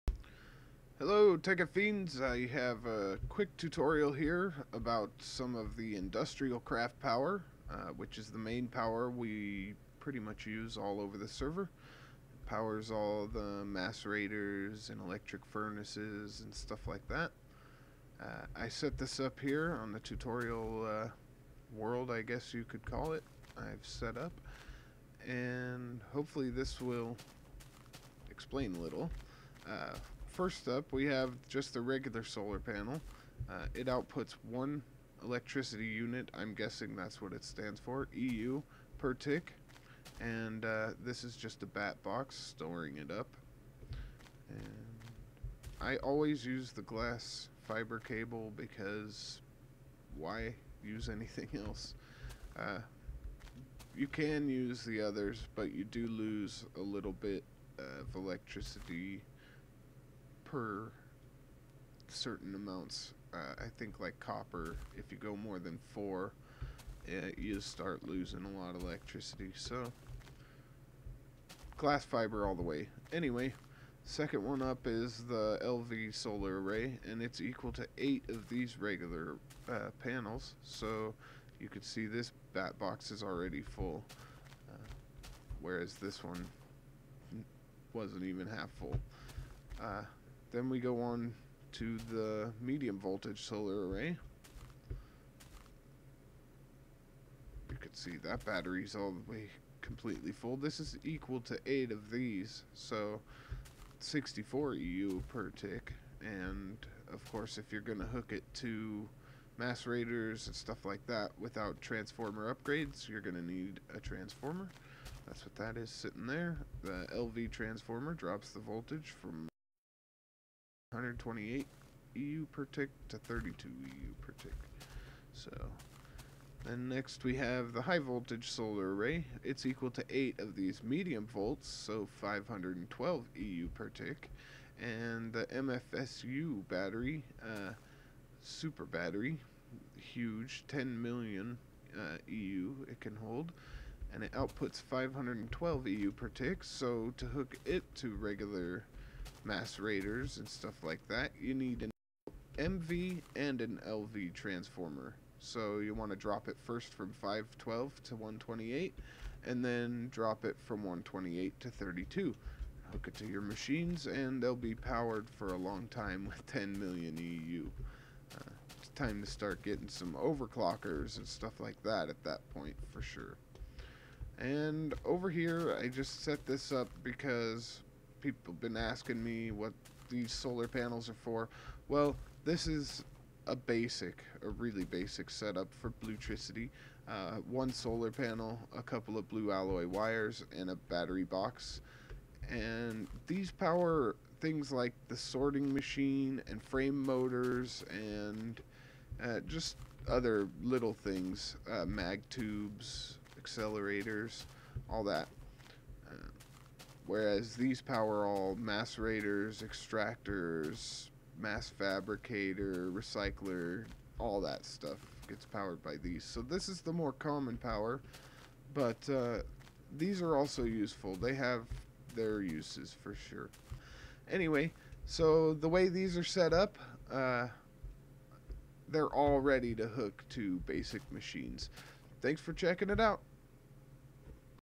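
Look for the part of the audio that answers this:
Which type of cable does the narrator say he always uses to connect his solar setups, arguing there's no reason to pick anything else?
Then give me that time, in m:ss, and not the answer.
0:46.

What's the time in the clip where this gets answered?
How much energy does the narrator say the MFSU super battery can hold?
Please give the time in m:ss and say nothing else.
2:20.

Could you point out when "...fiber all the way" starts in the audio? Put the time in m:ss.
1:12.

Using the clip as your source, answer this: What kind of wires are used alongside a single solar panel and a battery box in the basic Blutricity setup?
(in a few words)
blue alloy wires.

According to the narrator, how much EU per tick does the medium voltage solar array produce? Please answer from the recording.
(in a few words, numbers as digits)
64 EU per tick.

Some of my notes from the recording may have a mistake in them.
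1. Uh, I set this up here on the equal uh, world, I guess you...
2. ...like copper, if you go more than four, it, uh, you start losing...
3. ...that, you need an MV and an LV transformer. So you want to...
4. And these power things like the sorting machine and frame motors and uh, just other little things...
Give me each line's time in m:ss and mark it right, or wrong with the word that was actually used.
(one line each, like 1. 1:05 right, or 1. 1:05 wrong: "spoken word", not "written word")
1. 0:18 wrong: "tutorial", not "equal"
2. 1:04 right
3. 2:31 right
4. 3:12 right.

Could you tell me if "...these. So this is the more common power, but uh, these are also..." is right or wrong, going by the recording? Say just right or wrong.
right.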